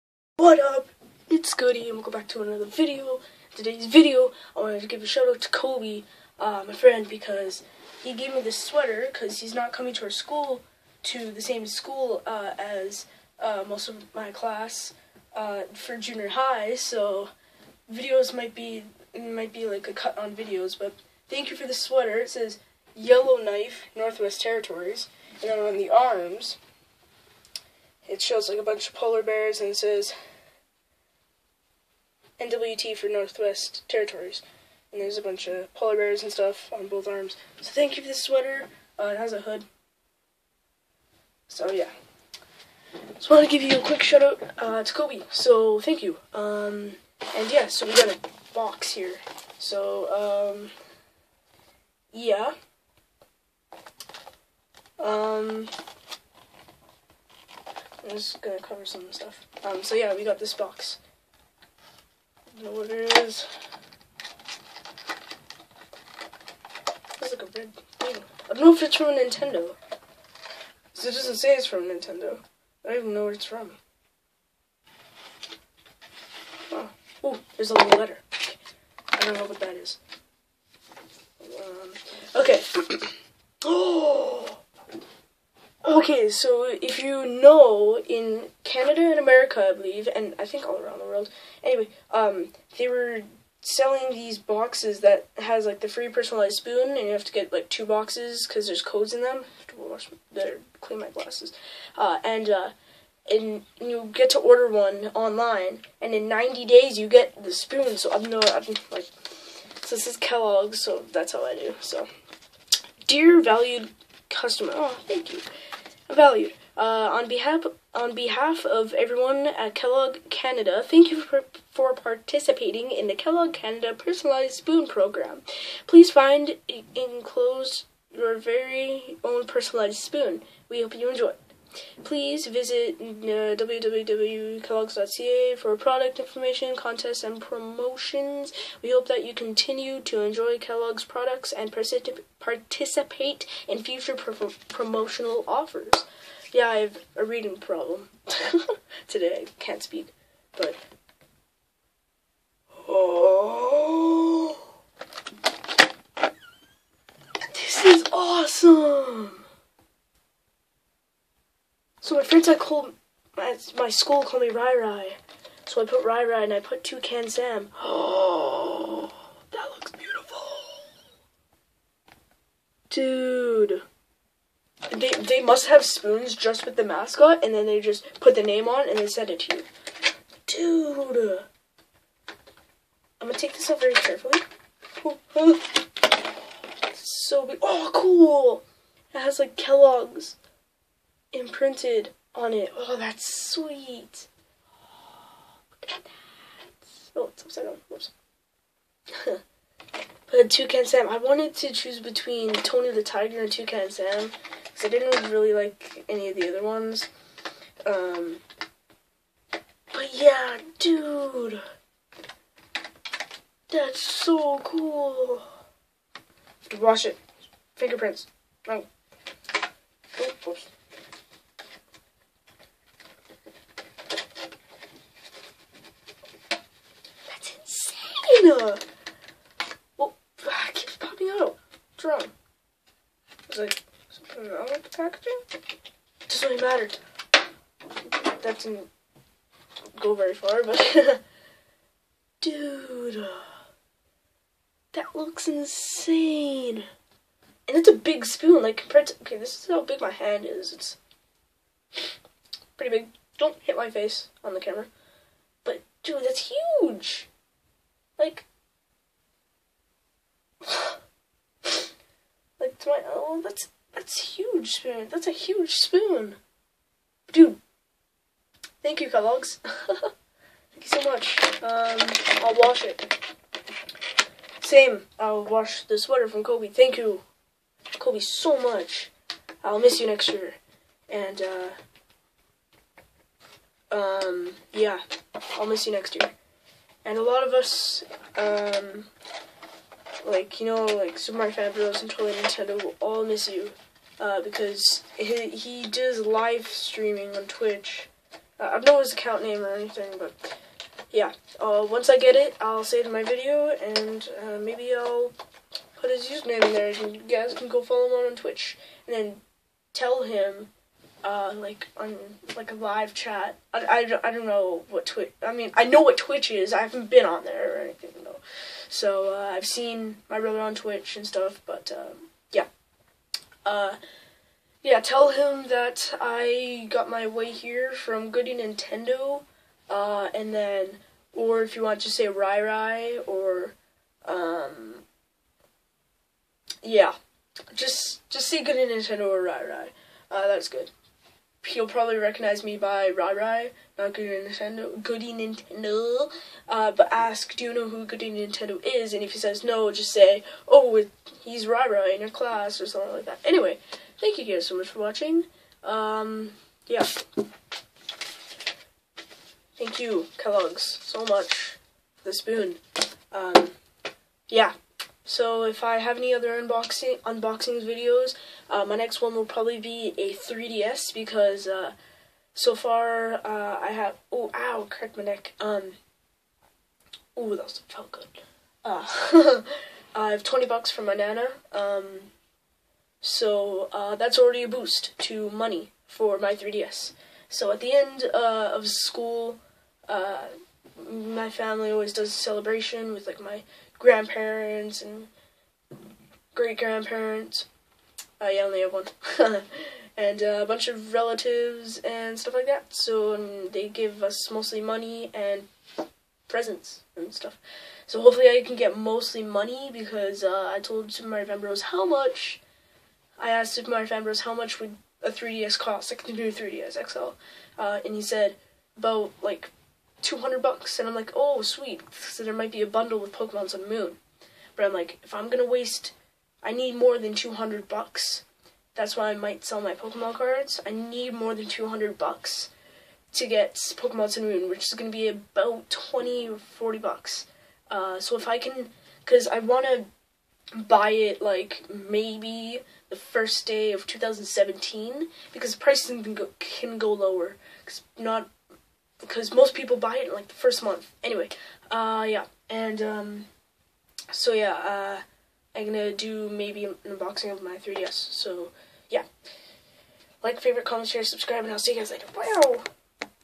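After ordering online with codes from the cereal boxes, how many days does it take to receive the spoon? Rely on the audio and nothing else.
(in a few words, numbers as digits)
90.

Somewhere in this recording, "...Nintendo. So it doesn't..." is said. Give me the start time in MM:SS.
01:09.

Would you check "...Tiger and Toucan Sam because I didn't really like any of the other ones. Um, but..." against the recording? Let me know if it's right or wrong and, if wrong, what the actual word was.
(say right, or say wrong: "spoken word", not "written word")
right.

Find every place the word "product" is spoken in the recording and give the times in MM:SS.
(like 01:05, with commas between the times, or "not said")
02:15, 02:21.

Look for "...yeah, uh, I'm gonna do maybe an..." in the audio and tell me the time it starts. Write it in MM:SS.
07:34.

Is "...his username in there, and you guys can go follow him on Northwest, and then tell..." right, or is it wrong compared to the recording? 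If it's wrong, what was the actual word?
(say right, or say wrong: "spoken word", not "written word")
wrong: "Twitch", not "Northwest".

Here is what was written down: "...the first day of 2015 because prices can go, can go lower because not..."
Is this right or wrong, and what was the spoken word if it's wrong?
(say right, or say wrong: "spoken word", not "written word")
wrong: "2017", not "2015".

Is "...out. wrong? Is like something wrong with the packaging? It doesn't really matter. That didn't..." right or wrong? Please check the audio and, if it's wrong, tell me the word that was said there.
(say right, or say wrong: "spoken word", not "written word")
right.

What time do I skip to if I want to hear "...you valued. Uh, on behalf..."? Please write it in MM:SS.
01:55.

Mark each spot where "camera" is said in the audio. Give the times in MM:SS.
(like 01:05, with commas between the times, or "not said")
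04:14.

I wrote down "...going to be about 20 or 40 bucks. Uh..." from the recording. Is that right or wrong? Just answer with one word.
right.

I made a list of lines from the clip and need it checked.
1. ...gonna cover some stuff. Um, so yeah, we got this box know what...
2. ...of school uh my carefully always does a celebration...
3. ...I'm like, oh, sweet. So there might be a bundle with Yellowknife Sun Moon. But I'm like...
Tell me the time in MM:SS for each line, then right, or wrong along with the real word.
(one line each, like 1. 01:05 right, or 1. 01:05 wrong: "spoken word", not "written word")
1. 00:58 right
2. 06:28 wrong: "family", not "carefully"
3. 07:01 wrong: "Pokemon", not "Yellowknife".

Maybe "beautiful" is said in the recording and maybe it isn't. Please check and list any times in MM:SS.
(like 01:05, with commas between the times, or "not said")
02:49.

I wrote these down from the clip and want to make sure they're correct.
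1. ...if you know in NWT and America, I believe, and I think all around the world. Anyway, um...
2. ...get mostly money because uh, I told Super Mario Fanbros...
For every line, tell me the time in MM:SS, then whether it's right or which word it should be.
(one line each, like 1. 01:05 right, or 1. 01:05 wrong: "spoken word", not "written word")
1. 01:26 wrong: "Canada", not "NWT"
2. 06:48 right.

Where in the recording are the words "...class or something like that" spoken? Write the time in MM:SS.
05:52.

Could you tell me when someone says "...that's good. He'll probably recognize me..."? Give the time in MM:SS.
05:40.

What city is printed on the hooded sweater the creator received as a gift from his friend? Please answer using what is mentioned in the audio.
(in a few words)
Yellowknife.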